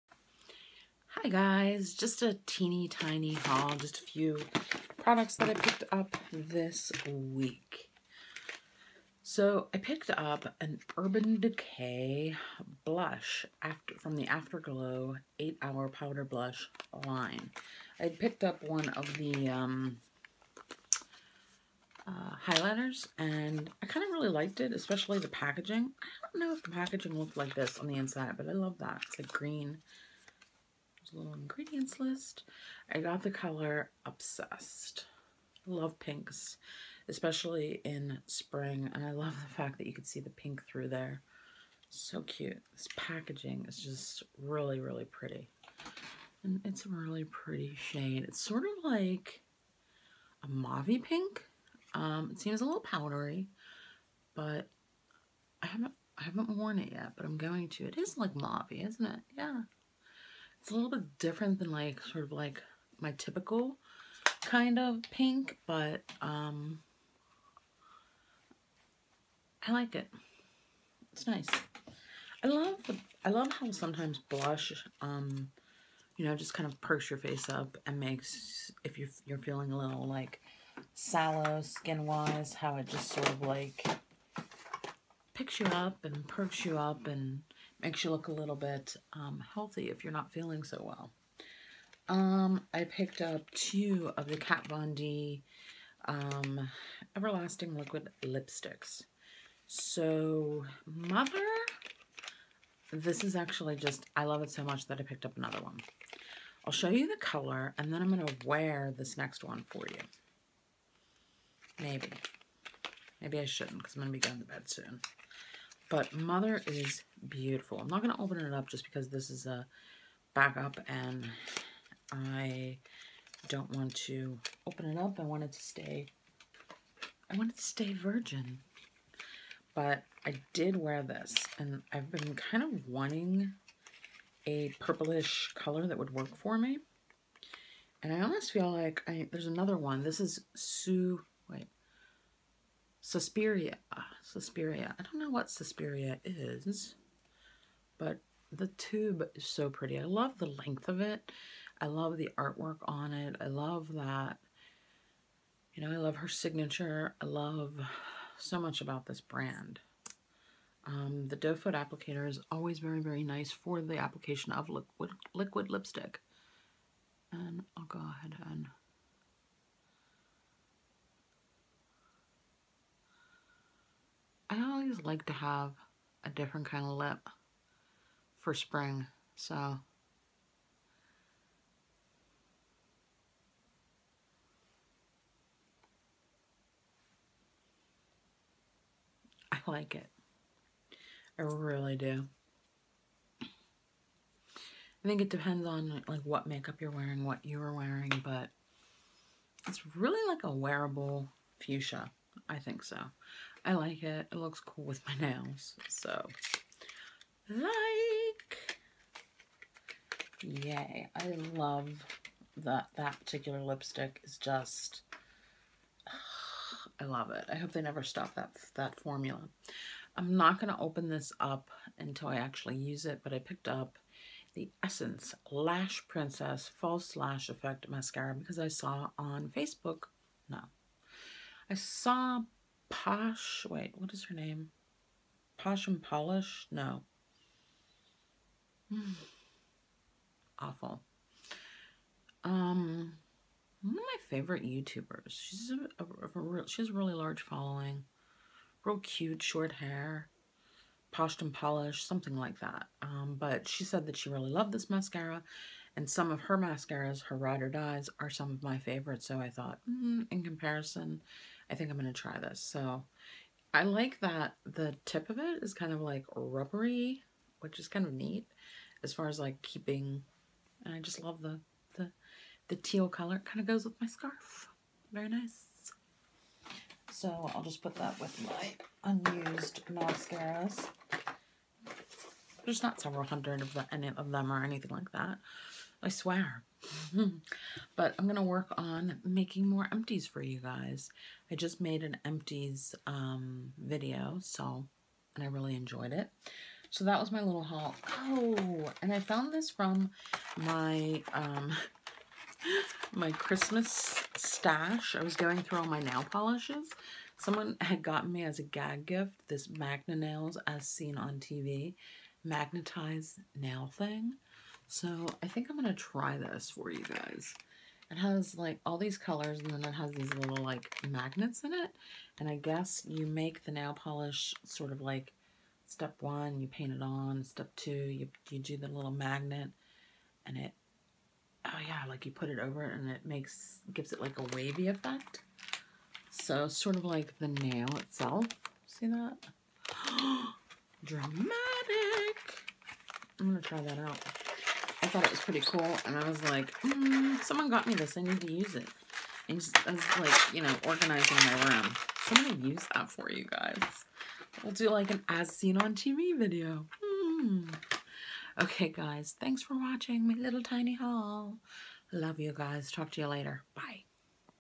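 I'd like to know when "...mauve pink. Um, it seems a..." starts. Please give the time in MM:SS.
00:50.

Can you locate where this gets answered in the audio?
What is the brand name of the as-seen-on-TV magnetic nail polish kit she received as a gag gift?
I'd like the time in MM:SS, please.
05:09.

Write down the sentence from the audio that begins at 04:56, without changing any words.
So that was my little haul.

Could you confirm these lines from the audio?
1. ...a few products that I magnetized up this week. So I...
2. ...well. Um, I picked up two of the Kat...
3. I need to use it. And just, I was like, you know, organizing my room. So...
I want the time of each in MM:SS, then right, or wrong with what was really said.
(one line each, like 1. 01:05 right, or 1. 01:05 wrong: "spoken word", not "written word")
1. 00:03 wrong: "picked", not "magnetized"
2. 01:30 right
3. 05:48 right.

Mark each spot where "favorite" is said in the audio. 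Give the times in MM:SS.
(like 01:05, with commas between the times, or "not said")
04:04, 04:18.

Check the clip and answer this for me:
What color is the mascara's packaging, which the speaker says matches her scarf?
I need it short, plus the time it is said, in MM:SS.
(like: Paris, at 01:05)
Teal, at 04:32.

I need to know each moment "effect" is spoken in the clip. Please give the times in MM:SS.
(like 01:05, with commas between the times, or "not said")
03:47, 05:34.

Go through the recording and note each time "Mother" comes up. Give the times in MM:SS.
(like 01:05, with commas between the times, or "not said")
01:40, 01:56.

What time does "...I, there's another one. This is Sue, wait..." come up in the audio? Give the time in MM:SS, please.
02:19.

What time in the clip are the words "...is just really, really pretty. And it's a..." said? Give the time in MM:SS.
00:43.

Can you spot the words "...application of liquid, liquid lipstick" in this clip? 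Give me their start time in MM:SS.
02:43.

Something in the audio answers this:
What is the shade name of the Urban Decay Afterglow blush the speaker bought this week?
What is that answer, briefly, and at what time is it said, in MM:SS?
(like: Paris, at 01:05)
Obsessed, at 00:34.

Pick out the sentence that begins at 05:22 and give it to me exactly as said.
And I guess you make the nail polish sort of like step one, you paint it on.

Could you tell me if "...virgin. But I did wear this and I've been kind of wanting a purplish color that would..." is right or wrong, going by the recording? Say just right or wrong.
right.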